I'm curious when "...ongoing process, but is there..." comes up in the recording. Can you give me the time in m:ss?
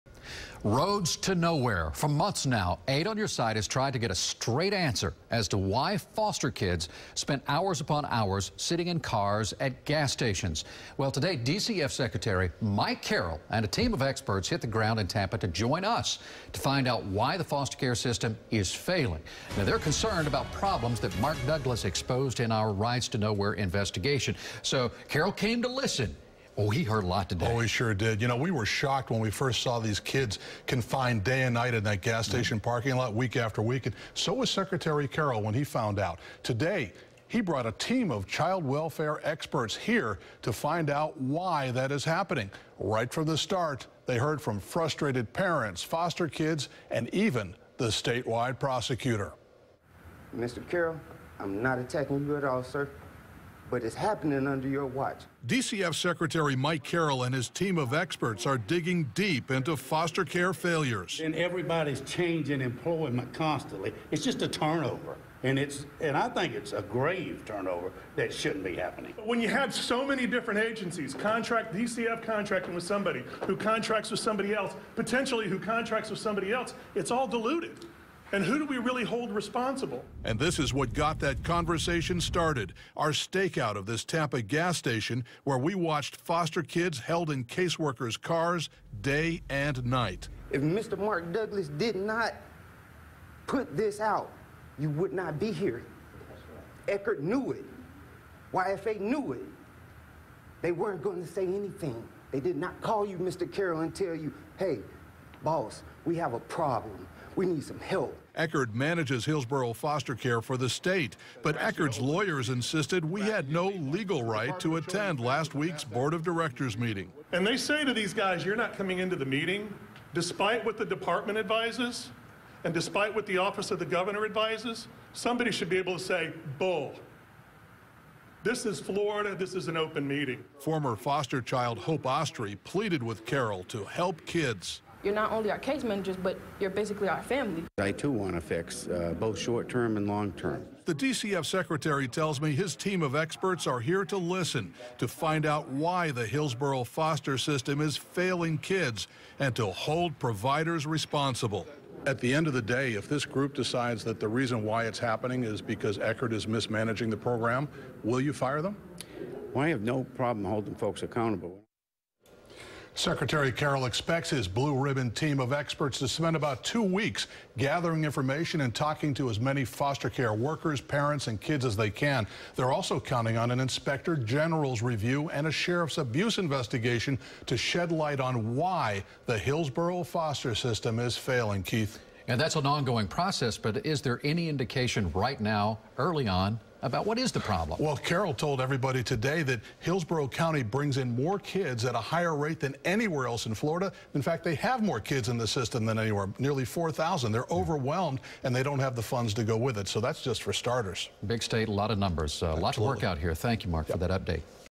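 3:02.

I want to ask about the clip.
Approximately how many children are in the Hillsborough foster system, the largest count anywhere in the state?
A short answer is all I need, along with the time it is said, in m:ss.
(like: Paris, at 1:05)
nearly 4,000, at 3:16.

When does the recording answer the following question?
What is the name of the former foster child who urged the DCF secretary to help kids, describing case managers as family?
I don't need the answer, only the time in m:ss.
2:11.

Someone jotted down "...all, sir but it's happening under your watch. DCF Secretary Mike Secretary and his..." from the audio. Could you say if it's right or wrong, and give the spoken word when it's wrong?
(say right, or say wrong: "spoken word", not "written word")
wrong: "Carroll", not "Secretary".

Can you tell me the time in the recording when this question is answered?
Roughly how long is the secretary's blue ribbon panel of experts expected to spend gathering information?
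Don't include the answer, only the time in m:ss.
2:46.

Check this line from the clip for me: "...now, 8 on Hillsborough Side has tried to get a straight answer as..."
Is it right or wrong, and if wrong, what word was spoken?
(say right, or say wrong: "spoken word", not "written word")
wrong: "Your", not "Hillsborough".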